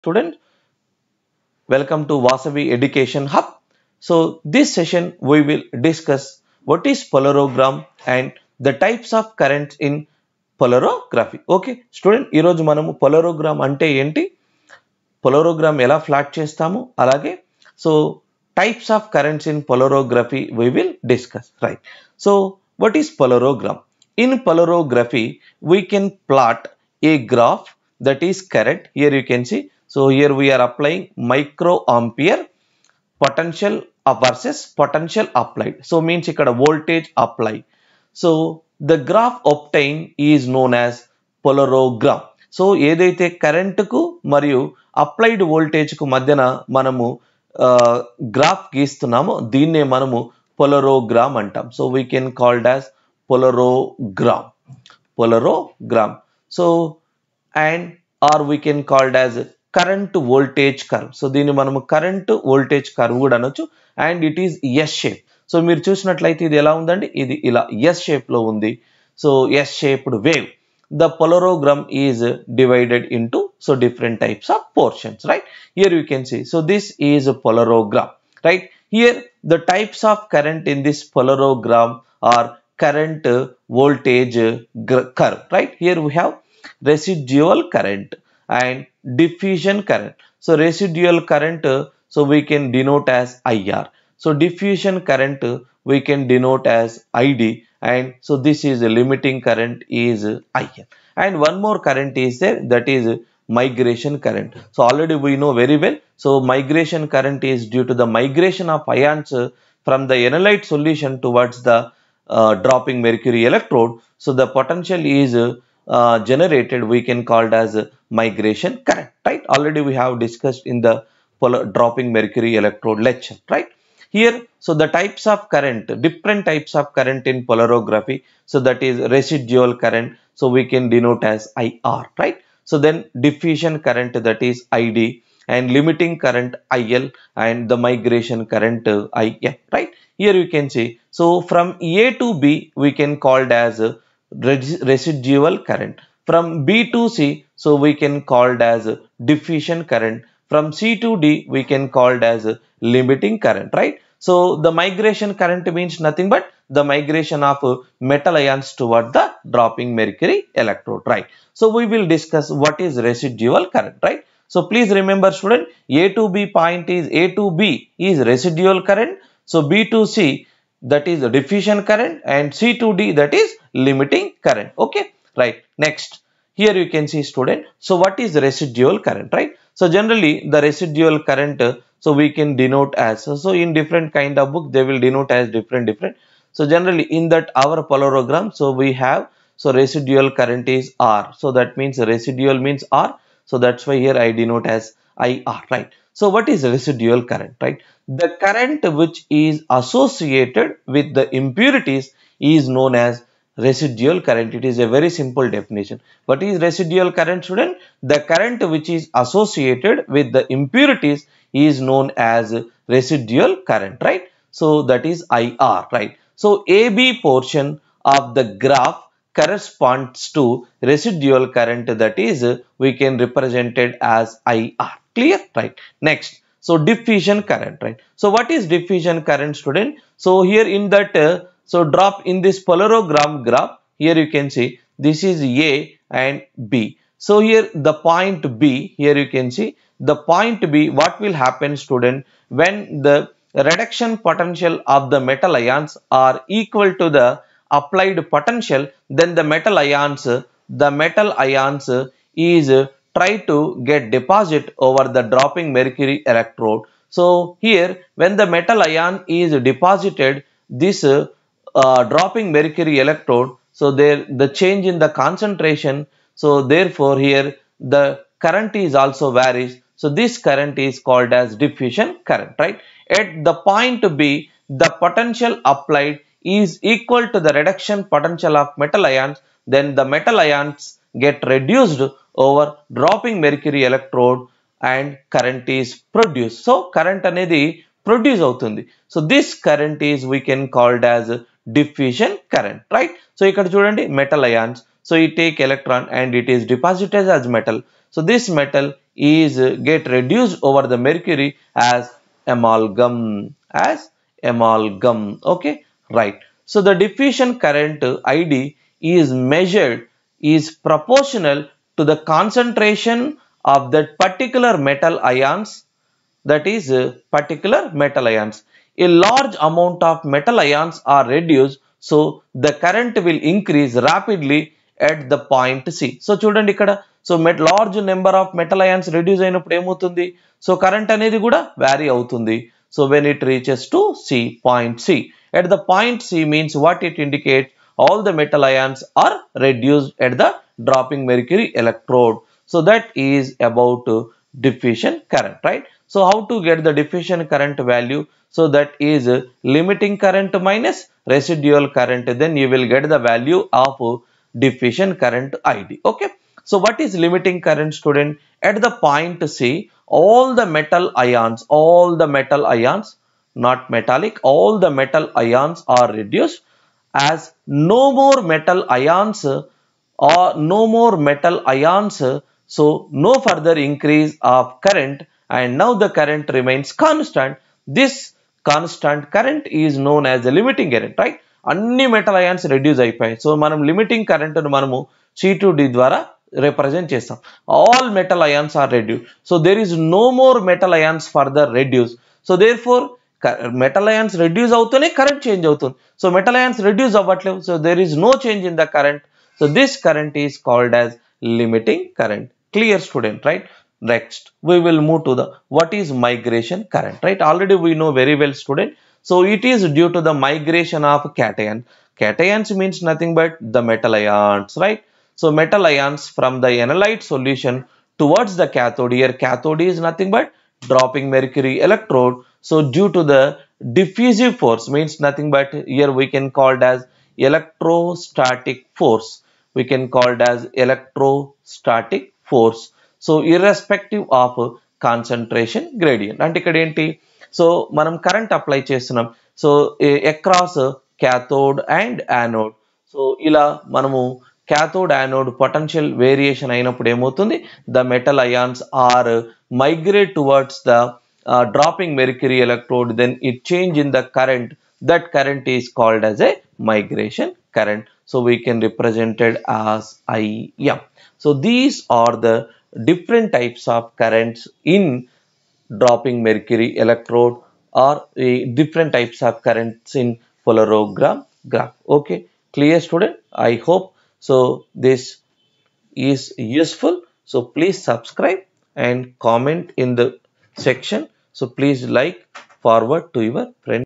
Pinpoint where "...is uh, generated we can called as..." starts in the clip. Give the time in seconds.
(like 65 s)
115 s.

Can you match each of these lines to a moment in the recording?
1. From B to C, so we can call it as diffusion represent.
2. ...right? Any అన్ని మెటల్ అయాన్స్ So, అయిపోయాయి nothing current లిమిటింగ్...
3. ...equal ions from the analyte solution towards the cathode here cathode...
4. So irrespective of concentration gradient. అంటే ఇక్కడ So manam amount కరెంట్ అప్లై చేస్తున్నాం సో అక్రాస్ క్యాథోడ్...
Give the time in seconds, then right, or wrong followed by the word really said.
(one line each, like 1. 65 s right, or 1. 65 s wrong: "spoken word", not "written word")
1. 146 s wrong: "current", not "represent"
2. 381 s wrong: "limiting", not "nothing"
3. 415 s wrong: "metal", not "equal"
4. 433 s wrong: "current", not "amount".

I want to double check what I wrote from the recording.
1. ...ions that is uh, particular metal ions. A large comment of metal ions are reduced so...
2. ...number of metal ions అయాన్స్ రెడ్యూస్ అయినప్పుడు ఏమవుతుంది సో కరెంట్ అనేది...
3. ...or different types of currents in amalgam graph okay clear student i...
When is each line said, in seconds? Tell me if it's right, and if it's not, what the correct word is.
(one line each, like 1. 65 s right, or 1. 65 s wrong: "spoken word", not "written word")
1. 315 s wrong: "amount", not "comment"
2. 328 s right
3. 468 s wrong: "polarogram", not "amalgam".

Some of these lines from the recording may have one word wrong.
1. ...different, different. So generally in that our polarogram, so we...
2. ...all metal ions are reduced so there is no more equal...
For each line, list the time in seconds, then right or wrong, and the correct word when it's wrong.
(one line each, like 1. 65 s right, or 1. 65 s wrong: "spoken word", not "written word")
1. 185 s right
2. 387 s wrong: "metal", not "equal".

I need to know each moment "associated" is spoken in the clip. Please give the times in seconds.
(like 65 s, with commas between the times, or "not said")
199 s, 209 s.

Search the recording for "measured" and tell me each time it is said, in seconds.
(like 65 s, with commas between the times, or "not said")
309 s.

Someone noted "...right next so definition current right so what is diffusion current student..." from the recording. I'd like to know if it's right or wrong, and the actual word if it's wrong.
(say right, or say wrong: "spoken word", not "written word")
wrong: "diffusion", not "definition".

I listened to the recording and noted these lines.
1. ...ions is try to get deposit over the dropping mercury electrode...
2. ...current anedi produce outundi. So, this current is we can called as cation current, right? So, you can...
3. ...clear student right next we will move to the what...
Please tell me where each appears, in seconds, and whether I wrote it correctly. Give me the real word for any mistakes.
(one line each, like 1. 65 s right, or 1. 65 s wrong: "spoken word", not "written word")
1. 251 s right
2. 286 s wrong: "diffusion", not "cation"
3. 402 s right.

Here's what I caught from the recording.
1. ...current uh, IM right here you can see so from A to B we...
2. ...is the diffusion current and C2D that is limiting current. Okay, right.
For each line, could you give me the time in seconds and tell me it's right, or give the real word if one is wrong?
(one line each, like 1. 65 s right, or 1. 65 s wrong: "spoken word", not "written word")
1. 138 s right
2. 171 s right.